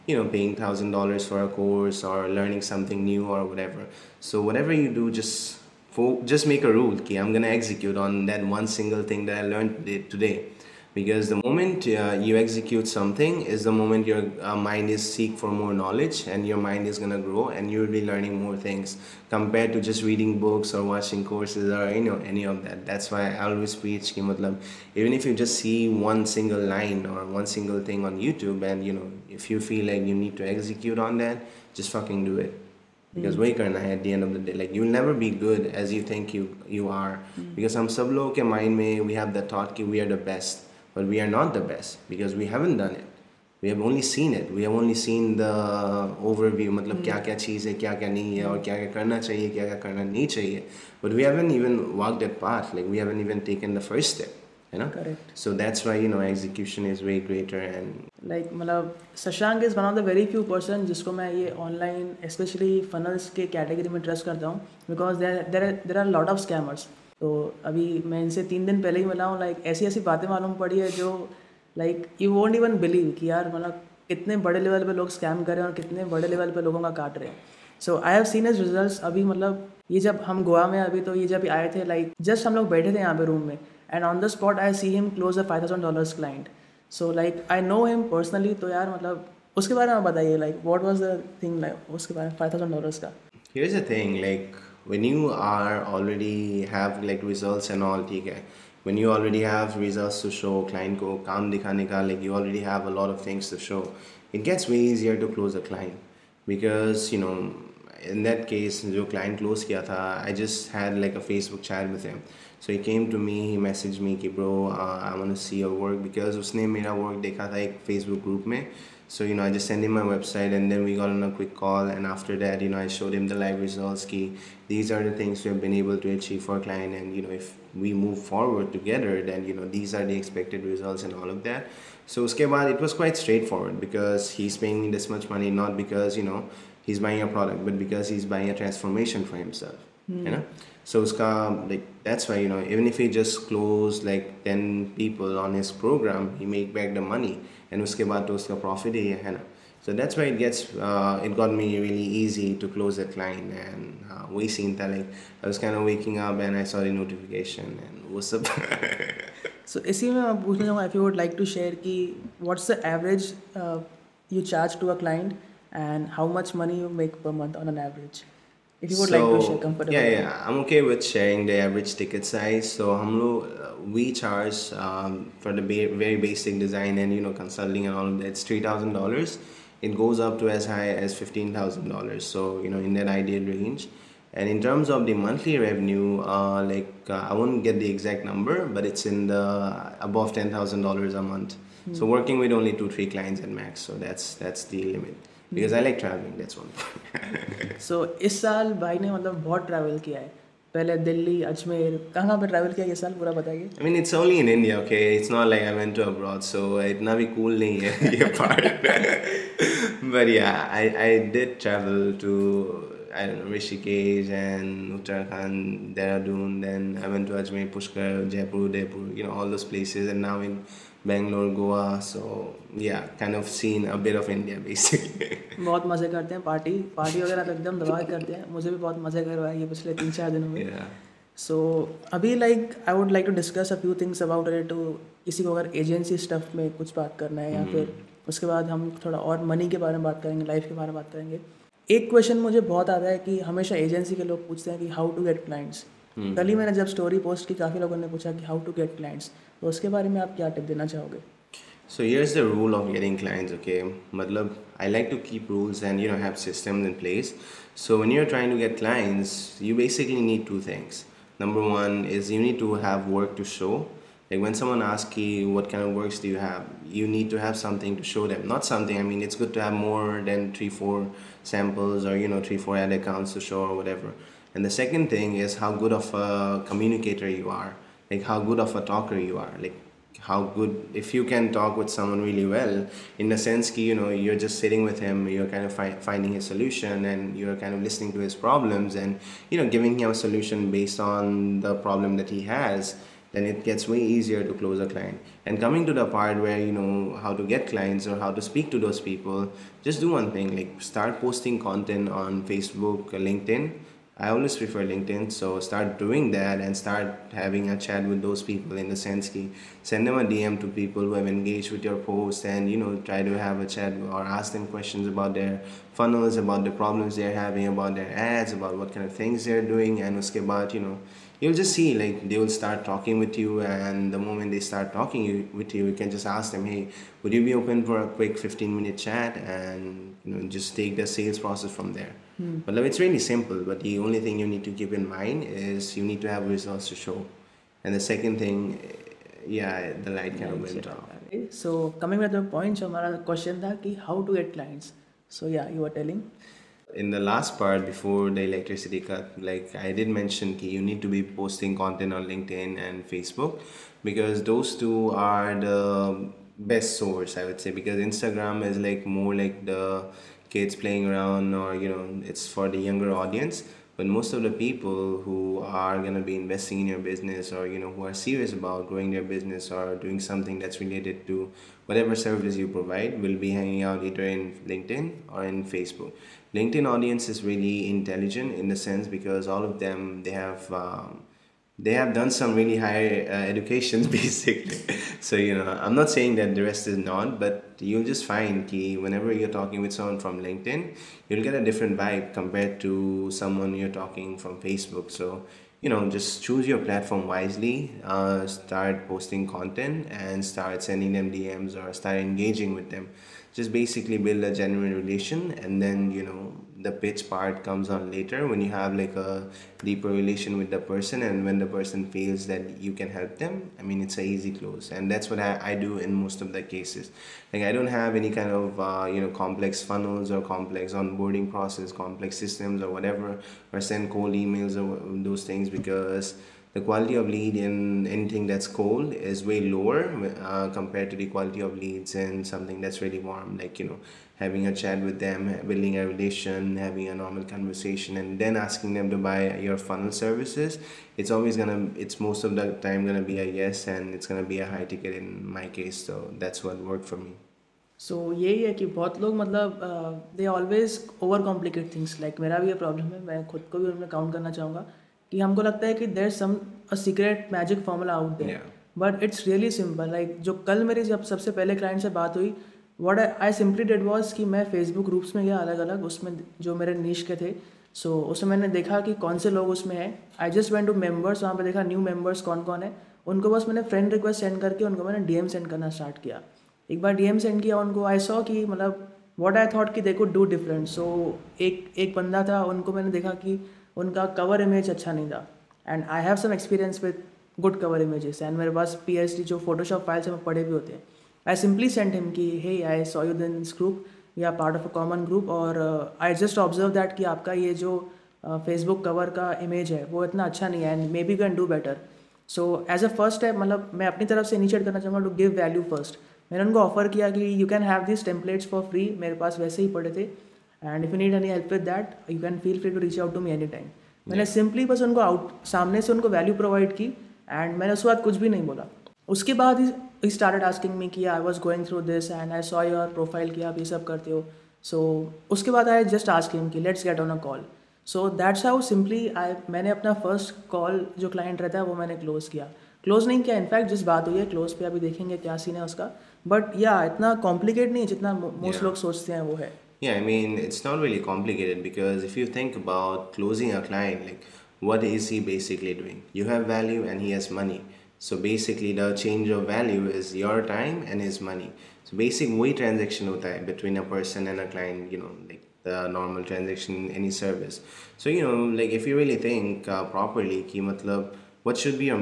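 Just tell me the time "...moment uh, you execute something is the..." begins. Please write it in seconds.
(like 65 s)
11 s.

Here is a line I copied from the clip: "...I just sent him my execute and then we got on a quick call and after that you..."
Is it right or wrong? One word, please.
wrong.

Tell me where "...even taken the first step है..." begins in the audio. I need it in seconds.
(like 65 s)
53 s.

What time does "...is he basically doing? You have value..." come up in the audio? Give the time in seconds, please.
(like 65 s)
545 s.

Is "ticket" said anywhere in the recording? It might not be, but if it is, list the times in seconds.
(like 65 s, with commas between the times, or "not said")
171 s, 444 s.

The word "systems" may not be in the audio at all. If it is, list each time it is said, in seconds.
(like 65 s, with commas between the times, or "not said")
256 s, 422 s.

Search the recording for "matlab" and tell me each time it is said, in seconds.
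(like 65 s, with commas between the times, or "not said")
254 s, 560 s.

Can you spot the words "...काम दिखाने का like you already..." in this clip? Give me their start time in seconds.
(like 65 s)
101 s.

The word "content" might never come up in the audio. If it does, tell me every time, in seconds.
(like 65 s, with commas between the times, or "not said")
301 s, 351 s, 399 s.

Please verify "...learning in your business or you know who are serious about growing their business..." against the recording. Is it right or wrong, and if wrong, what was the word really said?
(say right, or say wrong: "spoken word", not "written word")
wrong: "investing", not "learning".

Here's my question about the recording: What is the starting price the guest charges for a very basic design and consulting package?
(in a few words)
$3000.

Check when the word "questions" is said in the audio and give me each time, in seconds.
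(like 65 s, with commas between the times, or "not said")
314 s, 343 s.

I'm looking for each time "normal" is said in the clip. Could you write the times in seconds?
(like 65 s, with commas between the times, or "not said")
437 s, 556 s.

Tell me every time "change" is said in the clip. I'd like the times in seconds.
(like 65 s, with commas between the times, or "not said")
549 s.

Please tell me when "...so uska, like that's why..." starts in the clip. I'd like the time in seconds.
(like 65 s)
140 s.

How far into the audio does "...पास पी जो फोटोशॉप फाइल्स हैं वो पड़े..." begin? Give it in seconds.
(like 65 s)
488 s.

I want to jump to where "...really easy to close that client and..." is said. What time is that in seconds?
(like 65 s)
151 s.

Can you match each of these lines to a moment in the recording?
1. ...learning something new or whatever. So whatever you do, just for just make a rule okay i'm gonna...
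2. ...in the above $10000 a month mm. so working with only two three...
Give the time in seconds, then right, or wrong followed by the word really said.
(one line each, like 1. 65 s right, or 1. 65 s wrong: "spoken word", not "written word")
1. 2 s right
2. 189 s right.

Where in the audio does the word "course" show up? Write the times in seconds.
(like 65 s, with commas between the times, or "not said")
1 s, 21 s.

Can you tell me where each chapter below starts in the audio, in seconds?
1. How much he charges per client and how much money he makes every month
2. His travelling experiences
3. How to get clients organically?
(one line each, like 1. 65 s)
1. 159 s
2. 197 s
3. 231 s.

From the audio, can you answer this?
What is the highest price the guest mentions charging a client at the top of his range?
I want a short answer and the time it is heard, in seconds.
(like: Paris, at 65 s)
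$15000, at 181 s.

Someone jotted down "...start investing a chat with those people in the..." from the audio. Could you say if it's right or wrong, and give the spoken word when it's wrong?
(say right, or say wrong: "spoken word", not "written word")
wrong: "having", not "investing".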